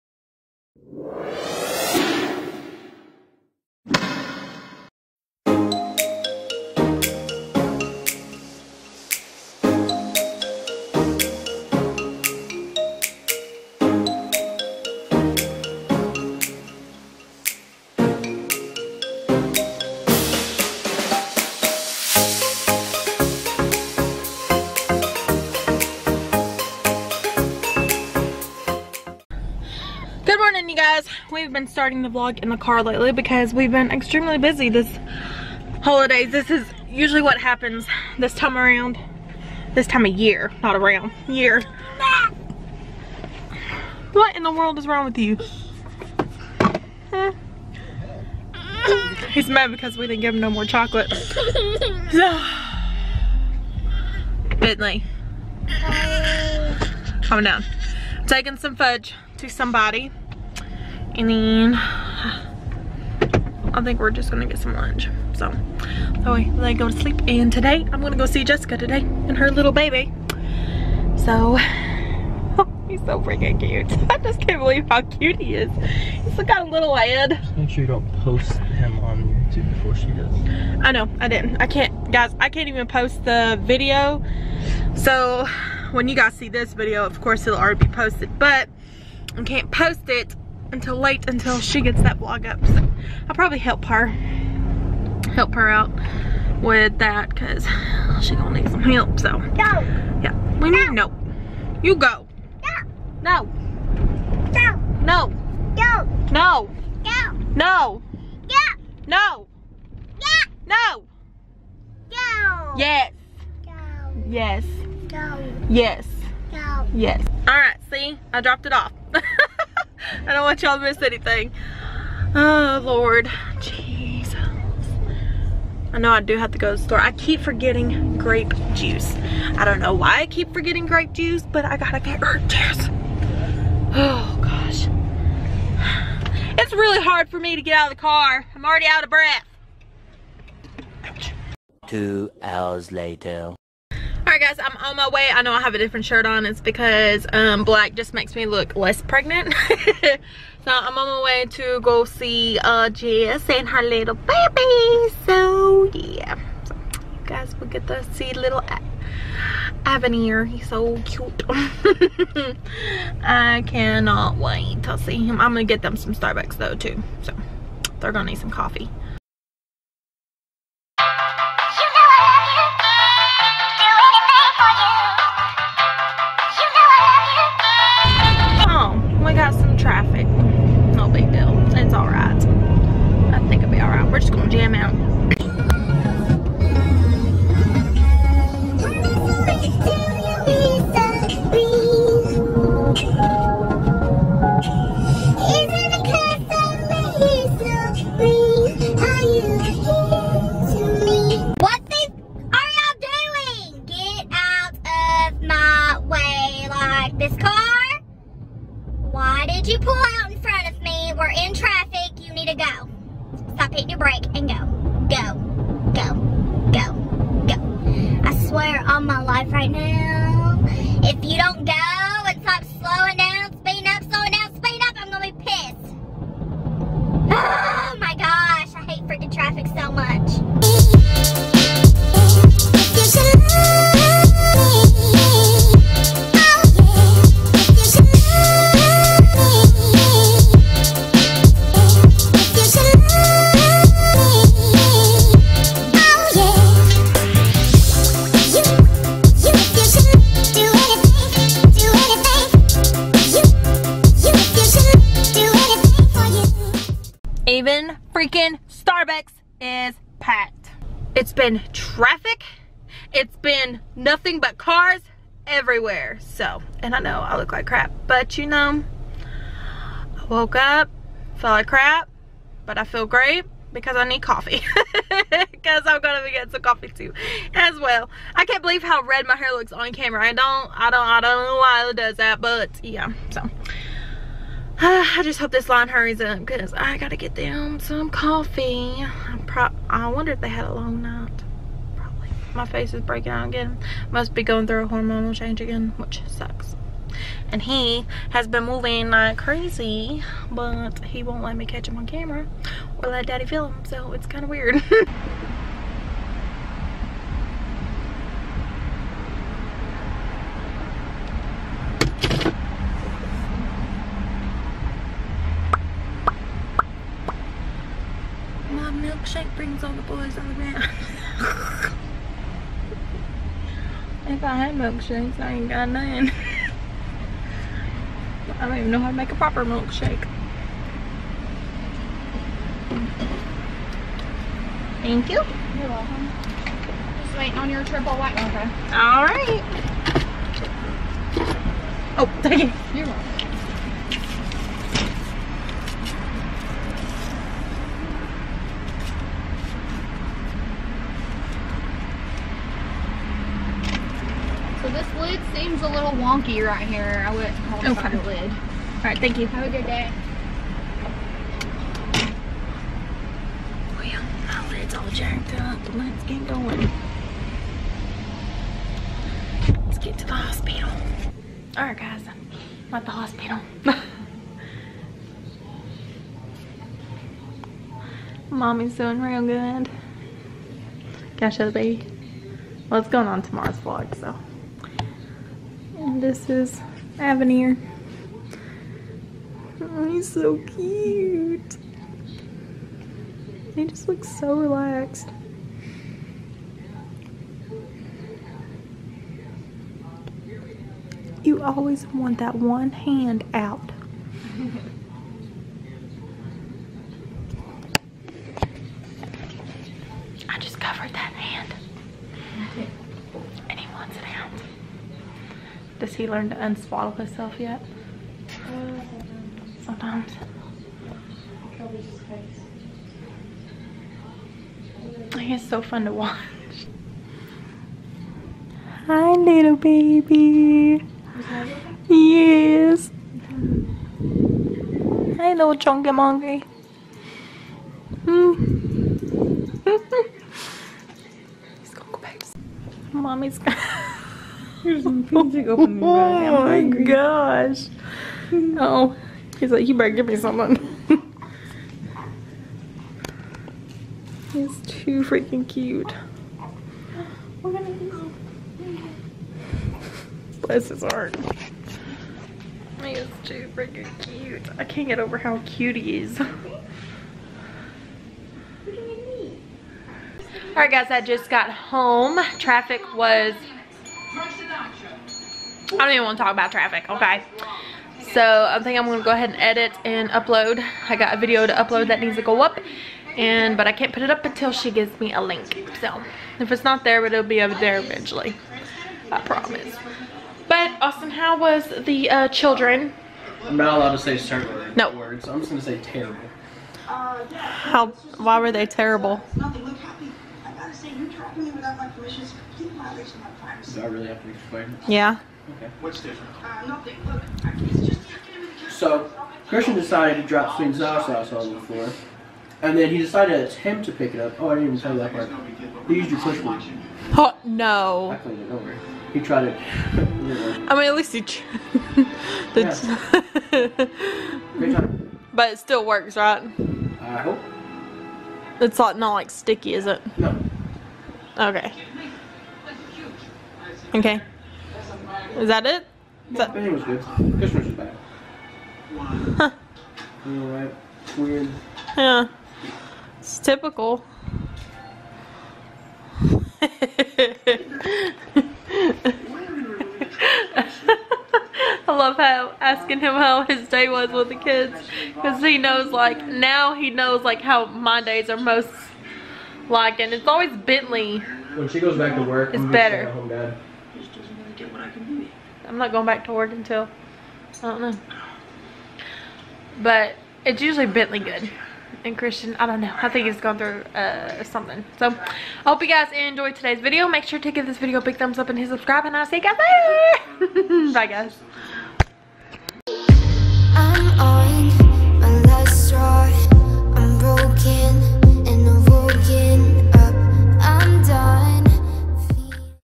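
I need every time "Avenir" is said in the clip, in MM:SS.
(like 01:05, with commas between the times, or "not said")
02:39, 06:27.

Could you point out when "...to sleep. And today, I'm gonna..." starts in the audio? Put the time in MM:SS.
01:06.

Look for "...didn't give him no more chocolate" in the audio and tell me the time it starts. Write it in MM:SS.
00:50.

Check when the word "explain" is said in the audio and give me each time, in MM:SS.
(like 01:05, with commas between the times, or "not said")
08:24.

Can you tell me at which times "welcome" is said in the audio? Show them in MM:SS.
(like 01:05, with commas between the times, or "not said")
05:35, 05:43.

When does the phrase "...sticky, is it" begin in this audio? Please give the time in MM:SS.
08:49.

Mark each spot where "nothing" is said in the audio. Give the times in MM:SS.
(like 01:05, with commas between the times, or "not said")
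04:23, 08:26.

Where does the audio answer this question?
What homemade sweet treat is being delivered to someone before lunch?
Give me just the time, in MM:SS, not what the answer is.
00:58.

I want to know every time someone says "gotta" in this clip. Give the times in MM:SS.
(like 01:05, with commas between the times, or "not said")
02:11, 04:46.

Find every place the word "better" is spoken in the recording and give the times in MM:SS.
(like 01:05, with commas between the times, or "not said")
07:29, 09:22.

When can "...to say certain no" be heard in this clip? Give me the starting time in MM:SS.
08:14.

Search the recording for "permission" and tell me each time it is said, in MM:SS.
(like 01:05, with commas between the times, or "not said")
08:22.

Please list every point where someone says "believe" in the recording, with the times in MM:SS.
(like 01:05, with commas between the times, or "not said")
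01:14, 04:38.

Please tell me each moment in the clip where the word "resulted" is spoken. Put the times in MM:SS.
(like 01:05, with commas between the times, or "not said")
not said.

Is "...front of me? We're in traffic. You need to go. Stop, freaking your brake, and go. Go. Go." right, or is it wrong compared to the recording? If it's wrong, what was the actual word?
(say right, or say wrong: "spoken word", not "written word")
wrong: "hitting", not "freaking".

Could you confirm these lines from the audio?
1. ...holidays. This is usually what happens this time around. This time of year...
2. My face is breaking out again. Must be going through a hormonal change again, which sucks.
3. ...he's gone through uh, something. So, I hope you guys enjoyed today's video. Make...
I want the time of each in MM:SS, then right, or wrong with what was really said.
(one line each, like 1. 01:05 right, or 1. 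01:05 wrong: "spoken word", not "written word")
1. 00:35 right
2. 04:52 right
3. 09:33 right.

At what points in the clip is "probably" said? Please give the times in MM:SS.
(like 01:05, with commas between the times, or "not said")
01:33, 04:51.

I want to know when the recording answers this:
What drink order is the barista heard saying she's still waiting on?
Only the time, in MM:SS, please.
05:37.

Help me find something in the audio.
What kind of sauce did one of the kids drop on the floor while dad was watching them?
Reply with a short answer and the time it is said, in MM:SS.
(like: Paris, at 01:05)
sweet and sour sauce, at 08:30.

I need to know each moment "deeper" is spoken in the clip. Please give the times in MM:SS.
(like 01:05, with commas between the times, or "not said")
not said.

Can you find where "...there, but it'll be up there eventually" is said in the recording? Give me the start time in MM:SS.
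08:07.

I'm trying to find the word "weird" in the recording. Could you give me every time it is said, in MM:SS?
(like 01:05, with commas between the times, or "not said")
05:04, 09:01.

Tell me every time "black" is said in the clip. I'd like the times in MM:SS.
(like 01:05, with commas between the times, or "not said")
02:27.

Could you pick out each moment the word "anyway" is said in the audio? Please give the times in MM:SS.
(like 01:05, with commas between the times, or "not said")
not said.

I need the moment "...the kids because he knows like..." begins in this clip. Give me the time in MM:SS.
09:14.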